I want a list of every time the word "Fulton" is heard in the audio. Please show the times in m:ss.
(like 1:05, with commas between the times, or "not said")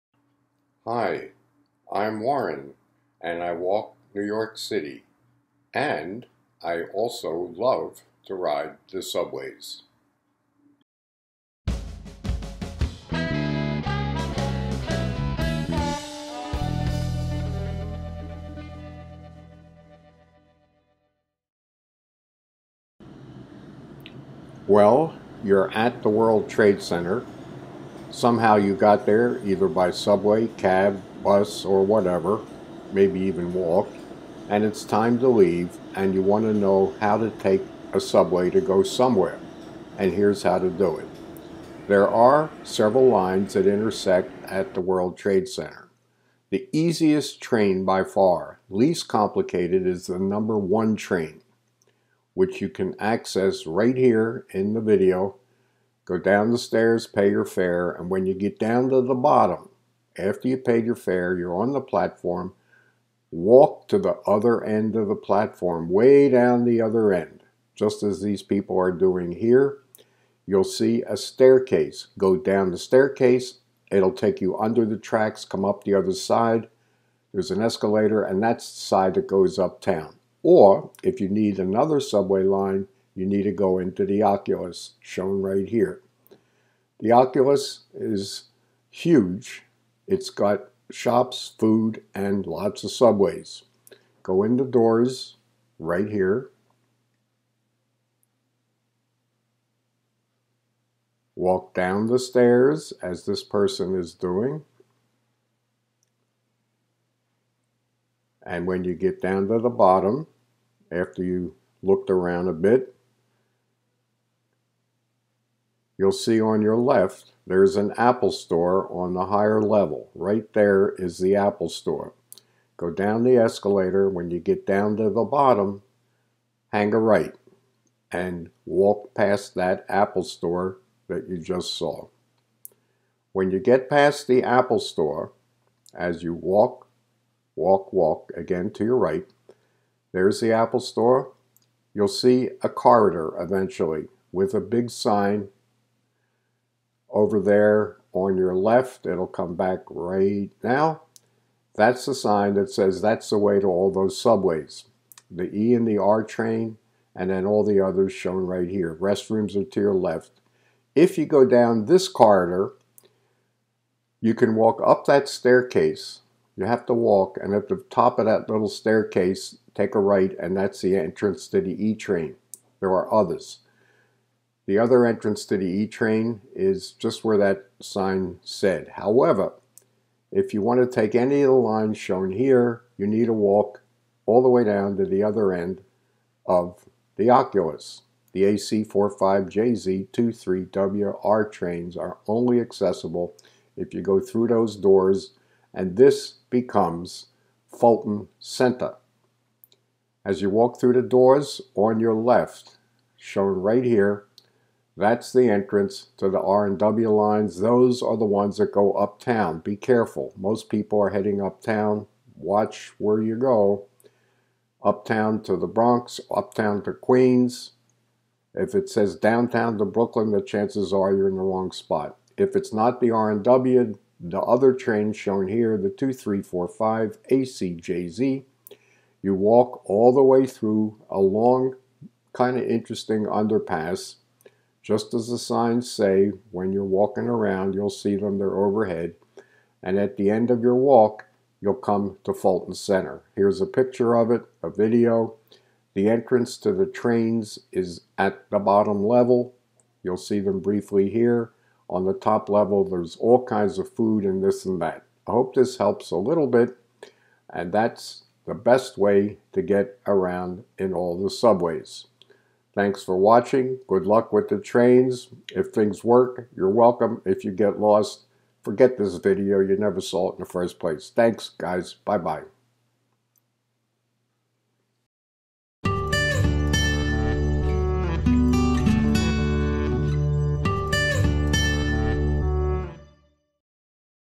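3:17, 4:02.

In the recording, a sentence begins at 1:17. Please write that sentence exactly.
There's an escalator, and that's the side that goes uptown.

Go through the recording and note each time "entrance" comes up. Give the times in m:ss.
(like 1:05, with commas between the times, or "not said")
2:50, 2:55, 3:25, 4:06.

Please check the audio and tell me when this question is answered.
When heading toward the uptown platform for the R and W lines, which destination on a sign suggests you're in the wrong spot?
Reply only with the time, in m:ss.
3:39.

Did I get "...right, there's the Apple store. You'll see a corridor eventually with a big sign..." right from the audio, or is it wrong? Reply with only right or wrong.
right.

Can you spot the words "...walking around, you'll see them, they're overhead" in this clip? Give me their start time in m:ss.
3:56.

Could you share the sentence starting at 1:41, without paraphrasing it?
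Walk down the stairs as this person is doing.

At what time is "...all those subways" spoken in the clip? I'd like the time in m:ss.
2:33.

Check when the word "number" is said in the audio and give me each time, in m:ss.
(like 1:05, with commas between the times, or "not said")
0:50.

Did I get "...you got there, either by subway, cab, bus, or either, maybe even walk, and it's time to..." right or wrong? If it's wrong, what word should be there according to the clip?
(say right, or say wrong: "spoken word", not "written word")
wrong: "whatever", not "either".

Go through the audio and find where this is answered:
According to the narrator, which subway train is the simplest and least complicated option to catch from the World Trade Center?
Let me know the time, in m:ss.
0:50.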